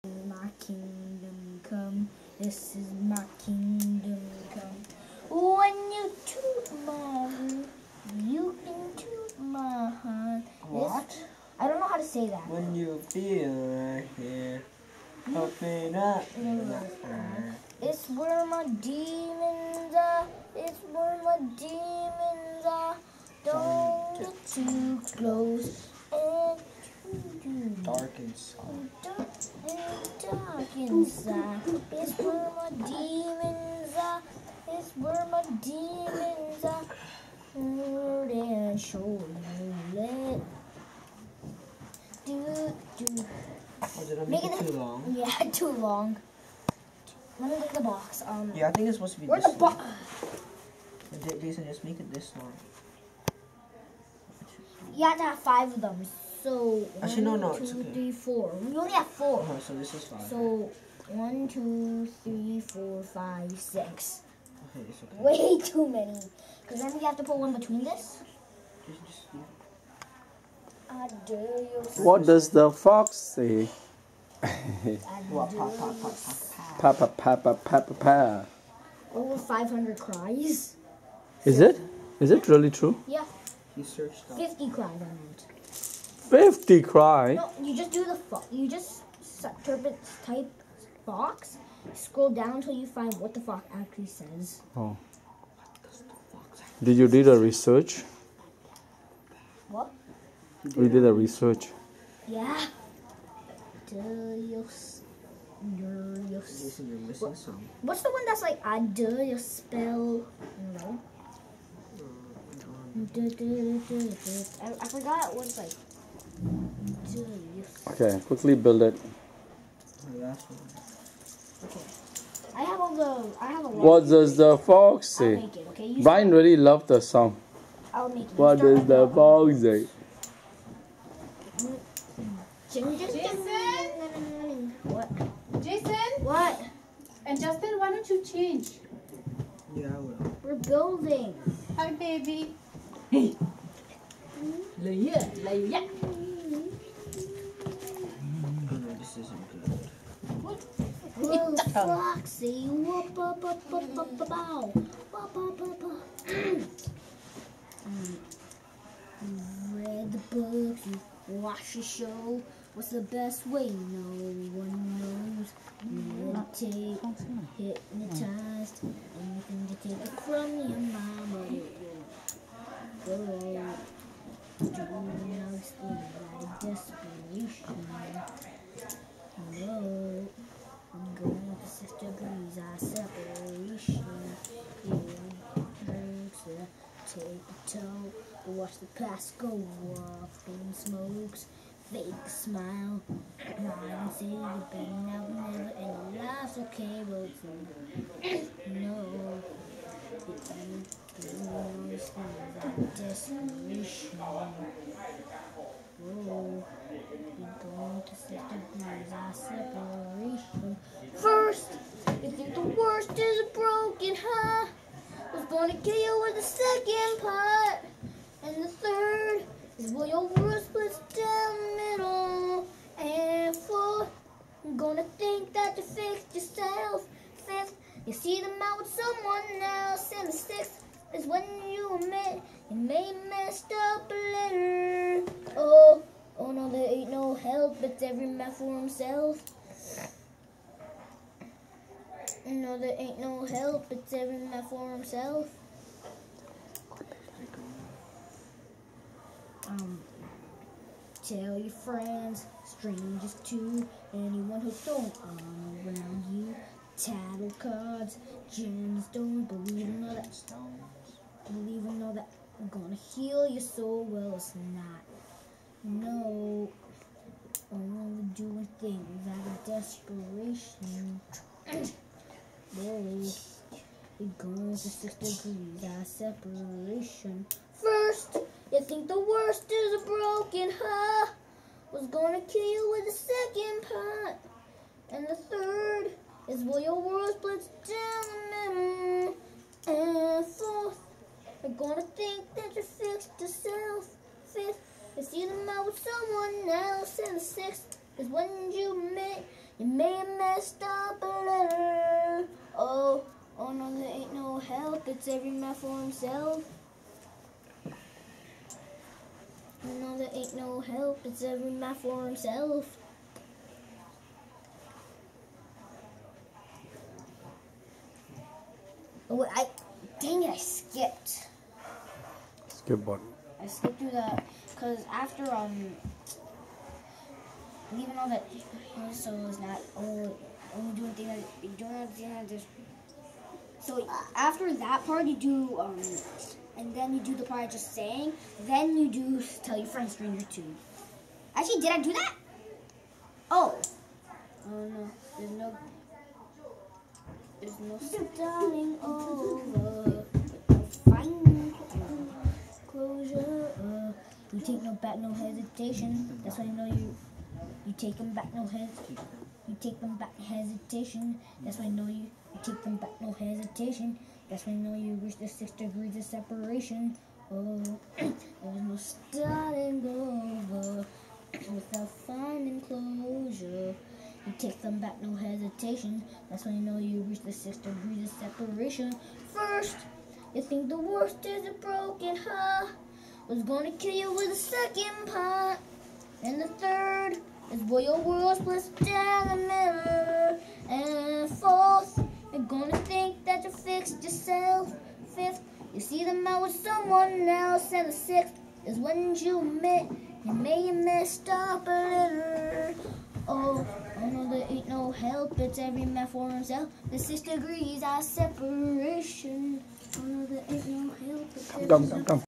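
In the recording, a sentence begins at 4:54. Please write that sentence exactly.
Fifth, is you them out with someone else.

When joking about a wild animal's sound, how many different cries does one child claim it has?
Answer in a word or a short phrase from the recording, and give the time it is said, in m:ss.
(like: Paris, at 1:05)
500, at 1:19.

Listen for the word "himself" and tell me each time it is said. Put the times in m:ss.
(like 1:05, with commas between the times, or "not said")
3:58, 4:04, 5:06, 5:12, 6:46.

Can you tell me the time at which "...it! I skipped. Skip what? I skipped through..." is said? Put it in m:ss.
5:20.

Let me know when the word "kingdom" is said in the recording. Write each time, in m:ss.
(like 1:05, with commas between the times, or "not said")
0:03.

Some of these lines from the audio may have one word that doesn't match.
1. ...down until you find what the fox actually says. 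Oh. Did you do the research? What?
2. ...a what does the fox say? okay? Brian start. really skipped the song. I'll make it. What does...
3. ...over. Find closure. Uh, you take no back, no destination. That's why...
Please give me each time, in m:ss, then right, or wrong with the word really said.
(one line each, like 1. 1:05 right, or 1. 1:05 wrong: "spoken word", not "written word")
1. 1:32 right
2. 2:03 wrong: "loved", not "skipped"
3. 5:49 wrong: "hesitation", not "destination".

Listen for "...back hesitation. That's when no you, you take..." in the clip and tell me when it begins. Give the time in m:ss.
6:00.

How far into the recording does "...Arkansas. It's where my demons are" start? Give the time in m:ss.
0:30.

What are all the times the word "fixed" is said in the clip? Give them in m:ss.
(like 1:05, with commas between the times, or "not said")
3:45, 4:52, 6:33.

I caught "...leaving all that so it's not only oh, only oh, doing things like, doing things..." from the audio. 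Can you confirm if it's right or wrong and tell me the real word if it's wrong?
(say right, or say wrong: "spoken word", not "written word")
right.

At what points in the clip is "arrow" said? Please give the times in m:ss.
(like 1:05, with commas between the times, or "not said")
not said.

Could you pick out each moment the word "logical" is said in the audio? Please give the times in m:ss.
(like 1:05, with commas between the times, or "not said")
not said.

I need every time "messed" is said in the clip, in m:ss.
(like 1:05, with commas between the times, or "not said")
3:53, 5:00, 6:40.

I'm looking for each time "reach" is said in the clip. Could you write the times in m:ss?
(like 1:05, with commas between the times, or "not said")
6:05, 6:17.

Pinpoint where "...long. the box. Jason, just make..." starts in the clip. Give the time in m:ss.
0:49.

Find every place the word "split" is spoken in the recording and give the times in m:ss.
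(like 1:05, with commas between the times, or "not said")
3:40, 4:47.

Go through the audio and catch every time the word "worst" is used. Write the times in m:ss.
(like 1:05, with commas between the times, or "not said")
3:32, 4:39, 6:20.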